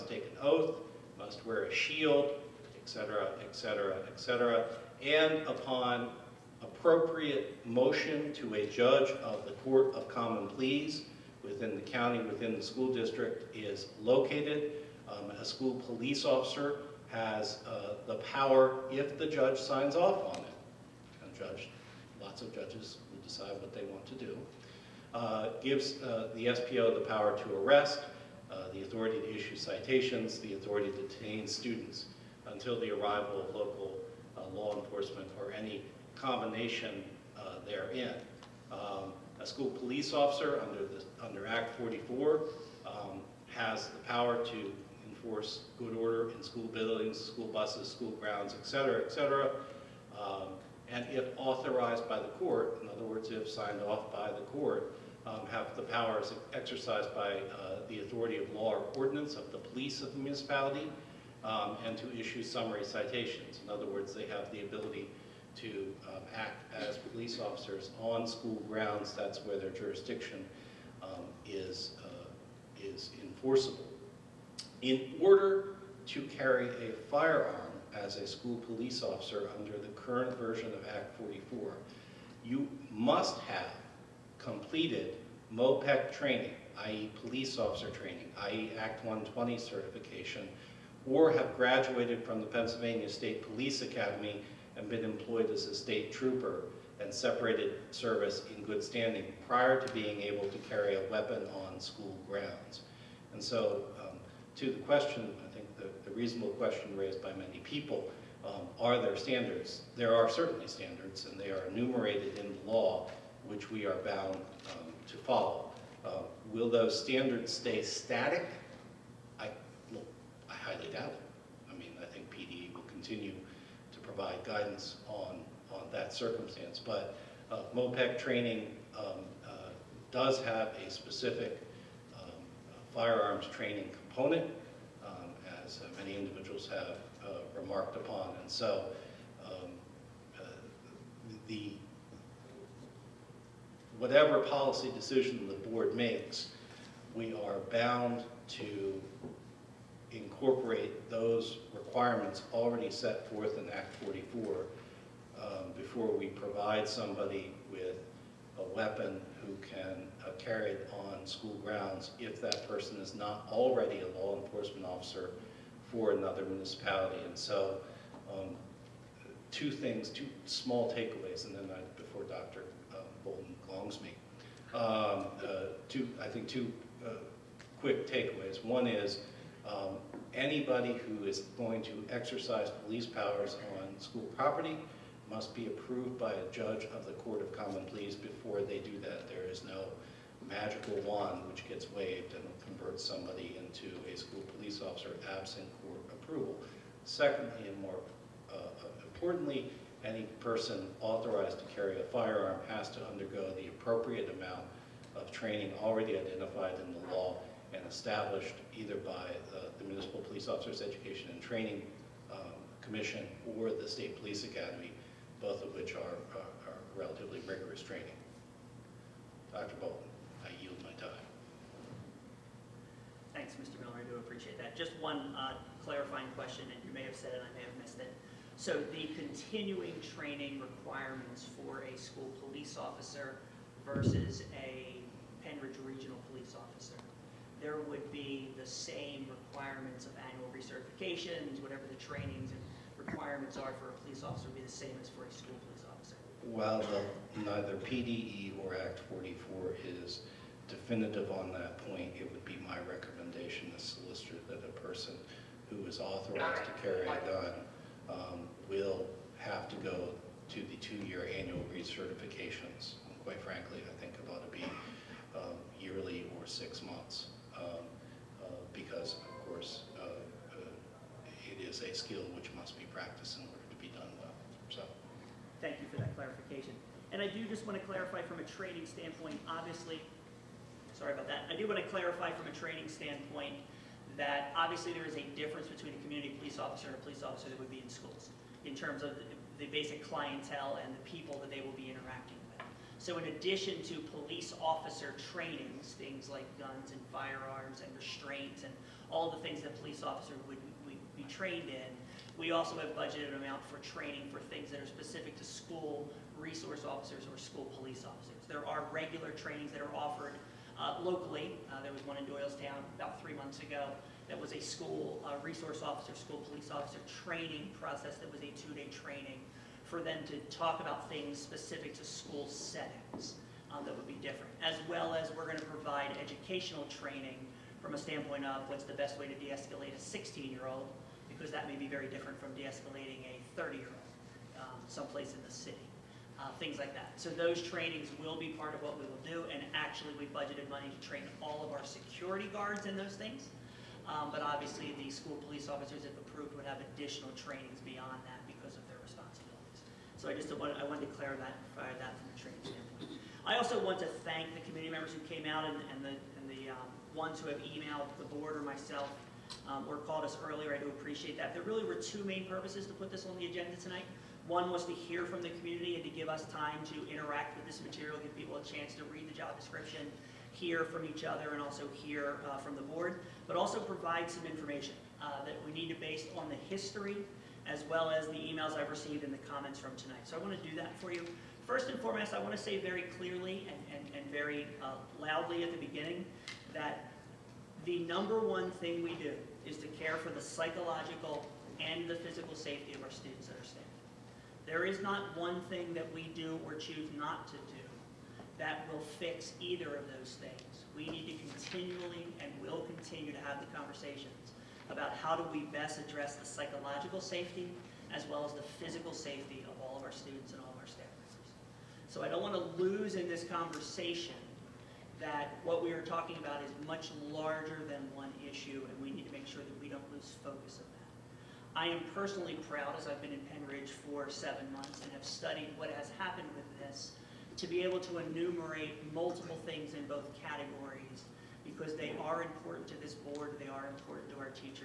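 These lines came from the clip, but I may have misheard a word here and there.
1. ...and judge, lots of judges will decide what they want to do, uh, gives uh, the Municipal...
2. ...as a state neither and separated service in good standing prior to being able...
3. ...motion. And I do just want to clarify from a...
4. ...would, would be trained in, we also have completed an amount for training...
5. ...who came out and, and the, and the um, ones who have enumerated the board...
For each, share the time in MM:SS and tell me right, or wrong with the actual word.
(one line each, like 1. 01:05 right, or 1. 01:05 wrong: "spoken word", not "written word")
1. 00:21 wrong: "SPO", not "Municipal"
2. 01:35 wrong: "trooper", not "neither"
3. 04:36 wrong: "clarification", not "motion"
4. 05:00 wrong: "budgeted", not "completed"
5. 05:55 wrong: "emailed", not "enumerated".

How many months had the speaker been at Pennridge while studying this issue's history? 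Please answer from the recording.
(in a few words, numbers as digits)
7.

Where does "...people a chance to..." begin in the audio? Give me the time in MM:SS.
06:08.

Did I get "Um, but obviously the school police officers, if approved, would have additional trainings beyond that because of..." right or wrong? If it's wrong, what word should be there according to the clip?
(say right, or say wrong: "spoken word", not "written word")
right.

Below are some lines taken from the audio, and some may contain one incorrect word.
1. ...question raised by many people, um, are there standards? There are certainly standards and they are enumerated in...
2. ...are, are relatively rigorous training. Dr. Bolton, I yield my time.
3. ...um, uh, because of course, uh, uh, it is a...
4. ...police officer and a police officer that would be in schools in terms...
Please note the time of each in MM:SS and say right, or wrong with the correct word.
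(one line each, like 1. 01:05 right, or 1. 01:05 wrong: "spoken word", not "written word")
1. 01:46 right
2. 03:36 right
3. 04:27 right
4. 04:46 right.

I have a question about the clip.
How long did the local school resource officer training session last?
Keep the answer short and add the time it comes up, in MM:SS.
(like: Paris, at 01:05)
2 days, at 05:18.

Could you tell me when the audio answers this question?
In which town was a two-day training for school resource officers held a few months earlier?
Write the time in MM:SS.
05:12.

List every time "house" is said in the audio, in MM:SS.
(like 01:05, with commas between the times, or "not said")
not said.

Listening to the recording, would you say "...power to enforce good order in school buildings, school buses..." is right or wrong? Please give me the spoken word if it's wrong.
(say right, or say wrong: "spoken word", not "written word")
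right.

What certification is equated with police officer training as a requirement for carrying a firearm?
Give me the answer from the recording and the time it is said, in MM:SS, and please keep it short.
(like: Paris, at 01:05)
Act 120 certification, at 01:28.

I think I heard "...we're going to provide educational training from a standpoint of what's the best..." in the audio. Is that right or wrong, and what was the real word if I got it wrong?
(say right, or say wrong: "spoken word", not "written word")
right.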